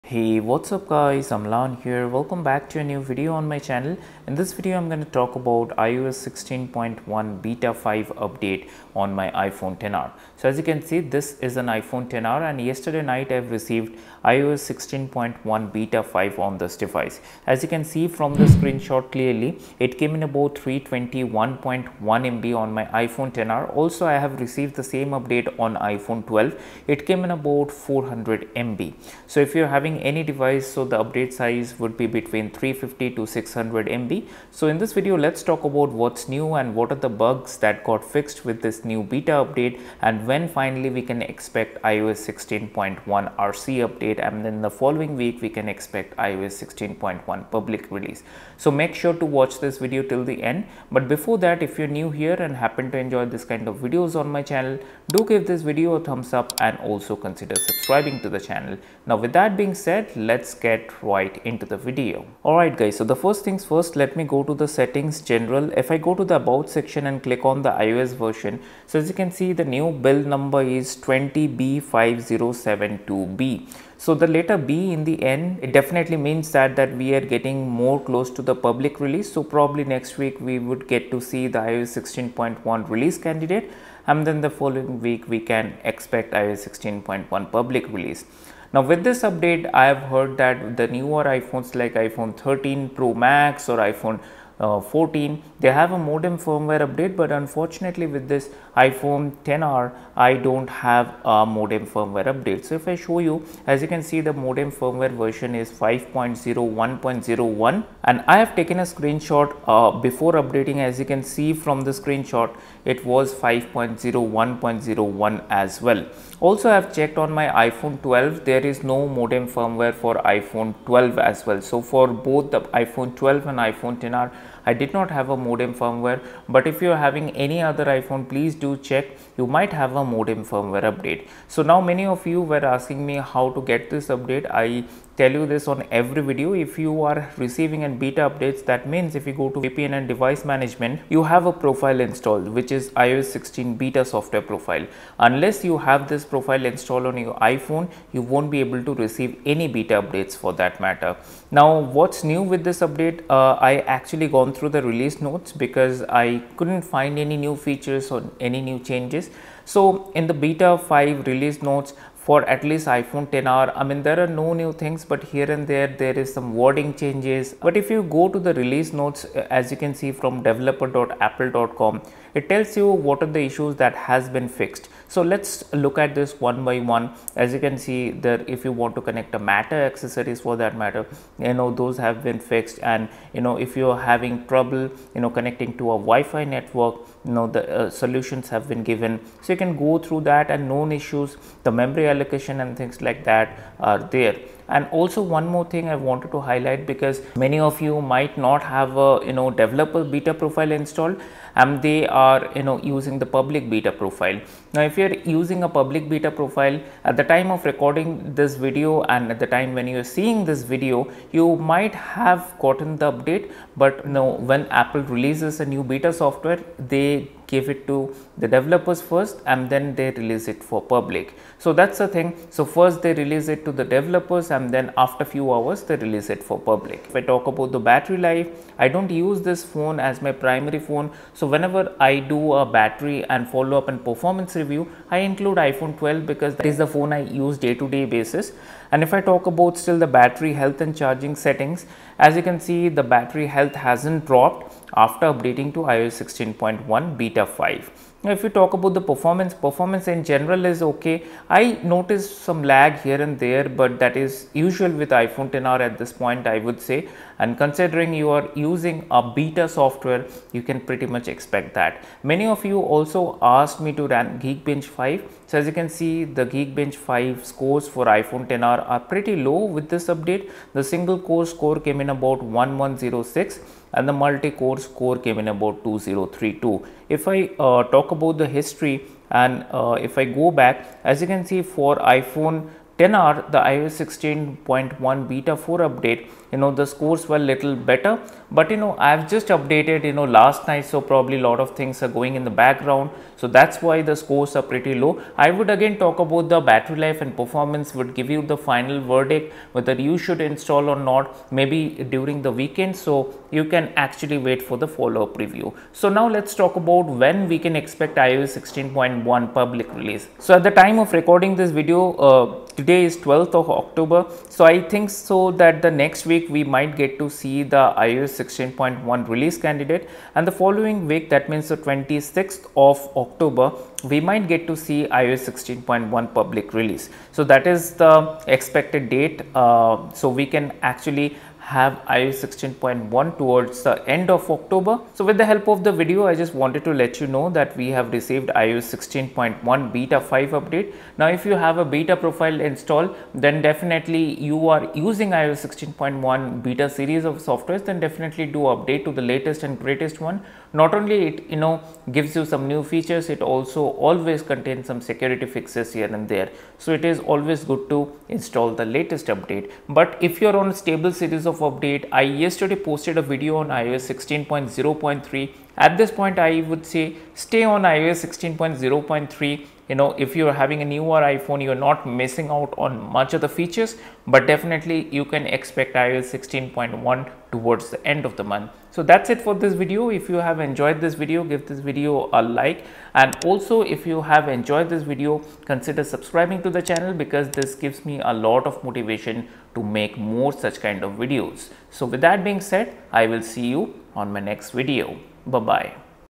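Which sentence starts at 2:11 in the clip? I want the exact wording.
So now many of you were asking me how to get this update.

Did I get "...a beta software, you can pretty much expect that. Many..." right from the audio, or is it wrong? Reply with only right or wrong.
right.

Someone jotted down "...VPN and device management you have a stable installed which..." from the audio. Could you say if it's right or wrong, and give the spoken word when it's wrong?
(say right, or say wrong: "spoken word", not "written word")
wrong: "profile", not "stable".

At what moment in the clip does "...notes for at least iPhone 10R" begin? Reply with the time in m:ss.
2:41.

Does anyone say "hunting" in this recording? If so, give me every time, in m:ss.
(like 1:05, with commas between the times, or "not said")
not said.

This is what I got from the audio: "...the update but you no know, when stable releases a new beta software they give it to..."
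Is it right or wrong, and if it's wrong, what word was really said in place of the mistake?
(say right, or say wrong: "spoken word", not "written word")
wrong: "apple", not "stable".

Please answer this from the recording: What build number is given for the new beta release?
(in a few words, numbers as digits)
20B5072B.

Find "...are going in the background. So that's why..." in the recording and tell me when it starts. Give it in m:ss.
4:52.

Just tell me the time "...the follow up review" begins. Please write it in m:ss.
5:04.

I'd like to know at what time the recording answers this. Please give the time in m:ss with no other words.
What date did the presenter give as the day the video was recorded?
5:13.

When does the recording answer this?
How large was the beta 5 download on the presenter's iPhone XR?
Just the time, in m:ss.
0:20.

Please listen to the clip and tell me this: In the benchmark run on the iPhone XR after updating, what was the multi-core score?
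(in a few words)
2032.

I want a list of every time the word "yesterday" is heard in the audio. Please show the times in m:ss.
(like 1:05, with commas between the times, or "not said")
0:12, 6:02.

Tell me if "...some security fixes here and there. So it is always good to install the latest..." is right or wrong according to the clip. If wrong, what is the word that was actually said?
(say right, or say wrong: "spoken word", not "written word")
right.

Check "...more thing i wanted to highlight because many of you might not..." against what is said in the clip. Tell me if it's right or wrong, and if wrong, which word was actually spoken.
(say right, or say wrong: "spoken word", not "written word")
right.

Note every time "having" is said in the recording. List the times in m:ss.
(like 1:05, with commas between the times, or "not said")
0:29, 2:07, 3:03, 6:10.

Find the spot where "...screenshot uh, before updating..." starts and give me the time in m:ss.
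1:48.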